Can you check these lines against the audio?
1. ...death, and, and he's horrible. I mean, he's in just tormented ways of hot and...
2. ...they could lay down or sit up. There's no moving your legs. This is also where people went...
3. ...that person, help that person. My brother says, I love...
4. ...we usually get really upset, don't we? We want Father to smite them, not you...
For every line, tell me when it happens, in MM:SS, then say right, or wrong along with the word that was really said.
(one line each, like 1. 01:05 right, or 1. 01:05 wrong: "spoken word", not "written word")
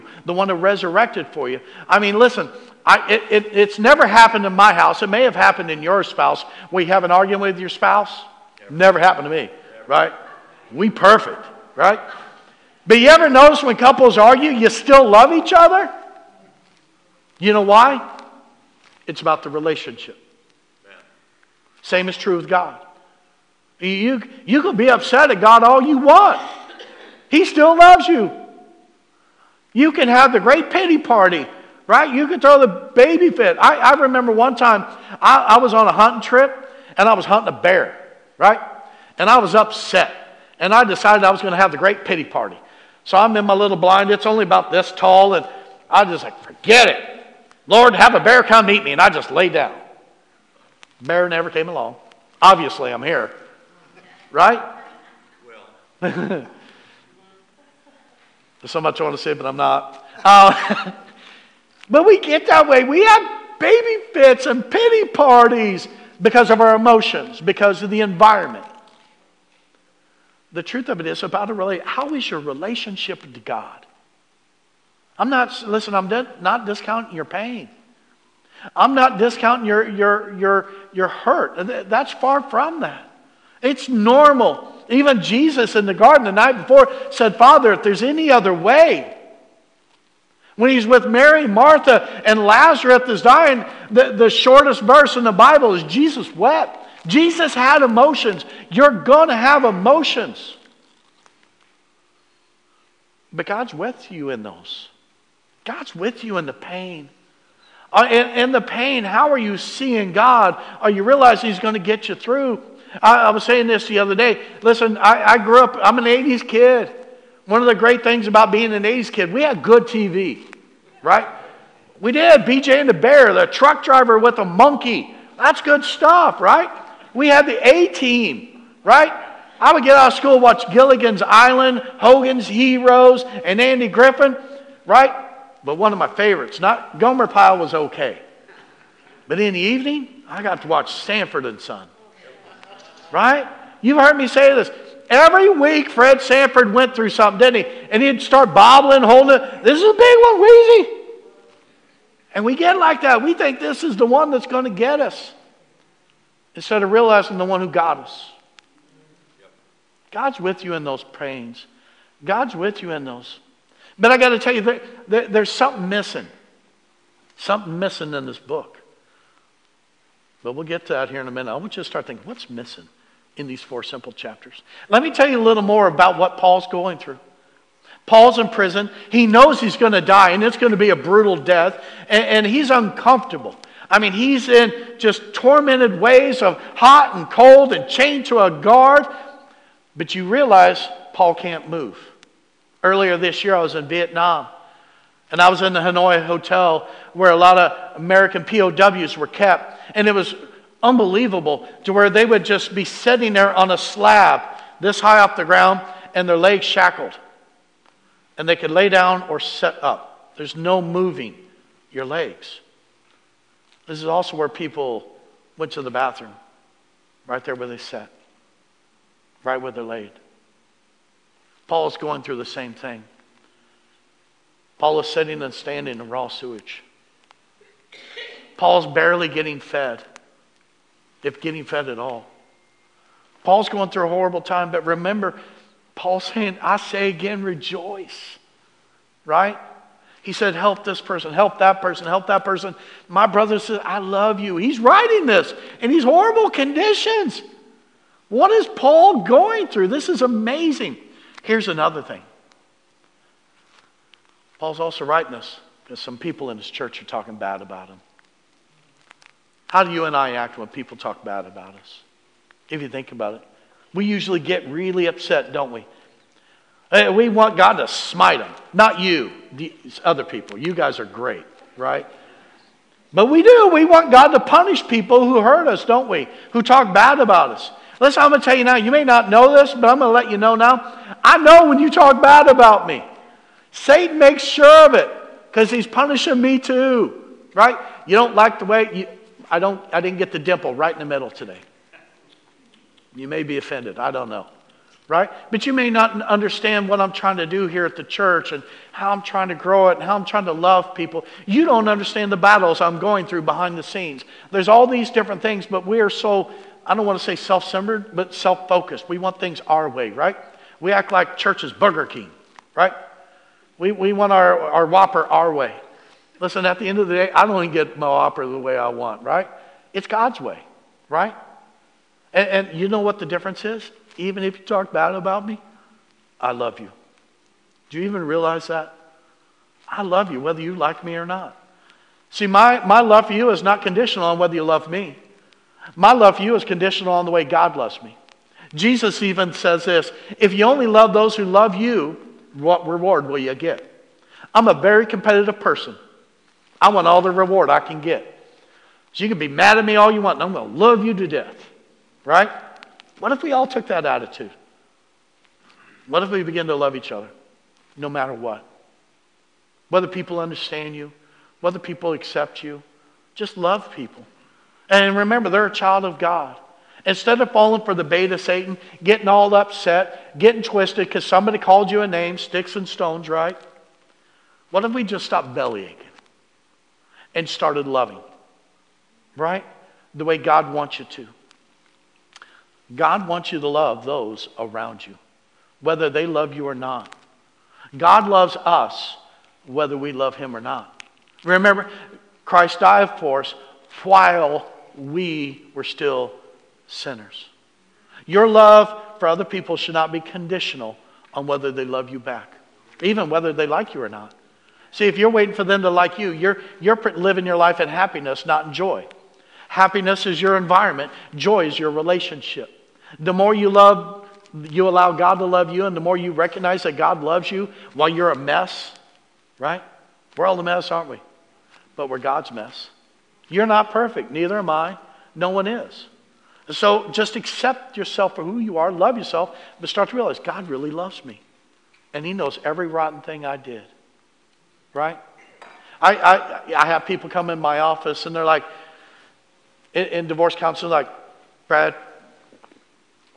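1. 03:01 wrong: "uncomfortable", not "horrible"
2. 03:28 right
3. 04:01 right
4. 04:23 wrong: "God", not "Father".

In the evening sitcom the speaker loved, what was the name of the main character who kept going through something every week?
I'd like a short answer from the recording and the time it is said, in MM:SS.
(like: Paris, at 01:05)
Fred Sanford, at 02:25.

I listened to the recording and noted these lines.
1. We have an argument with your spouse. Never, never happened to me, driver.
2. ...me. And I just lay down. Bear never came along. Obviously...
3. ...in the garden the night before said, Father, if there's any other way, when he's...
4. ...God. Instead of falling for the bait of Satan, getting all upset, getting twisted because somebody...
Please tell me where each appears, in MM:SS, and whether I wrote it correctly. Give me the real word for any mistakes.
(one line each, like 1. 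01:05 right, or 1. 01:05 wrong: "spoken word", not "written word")
1. 00:06 wrong: "never", not "driver"
2. 00:48 right
3. 01:25 right
4. 06:06 right.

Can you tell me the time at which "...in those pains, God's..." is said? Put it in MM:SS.
02:40.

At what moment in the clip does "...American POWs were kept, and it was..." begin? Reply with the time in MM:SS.
03:17.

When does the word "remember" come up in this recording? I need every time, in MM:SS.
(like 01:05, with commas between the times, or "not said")
00:34, 03:54, 06:05, 06:31.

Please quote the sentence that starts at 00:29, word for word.
You can have the great pity party, right?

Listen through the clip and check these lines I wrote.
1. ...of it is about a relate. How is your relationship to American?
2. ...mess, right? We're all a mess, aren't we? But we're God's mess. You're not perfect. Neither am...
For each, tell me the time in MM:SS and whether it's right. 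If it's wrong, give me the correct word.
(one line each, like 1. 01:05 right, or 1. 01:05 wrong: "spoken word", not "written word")
1. 01:10 wrong: "God", not "American"
2. 06:58 right.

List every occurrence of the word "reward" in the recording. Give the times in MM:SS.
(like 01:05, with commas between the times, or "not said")
05:42, 05:47.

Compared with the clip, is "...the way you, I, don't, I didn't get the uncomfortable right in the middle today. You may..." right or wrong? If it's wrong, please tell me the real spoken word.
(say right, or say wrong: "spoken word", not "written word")
wrong: "dimple", not "uncomfortable".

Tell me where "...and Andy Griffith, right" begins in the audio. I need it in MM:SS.
02:13.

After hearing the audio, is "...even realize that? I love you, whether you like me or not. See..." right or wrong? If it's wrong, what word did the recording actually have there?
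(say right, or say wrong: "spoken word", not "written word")
right.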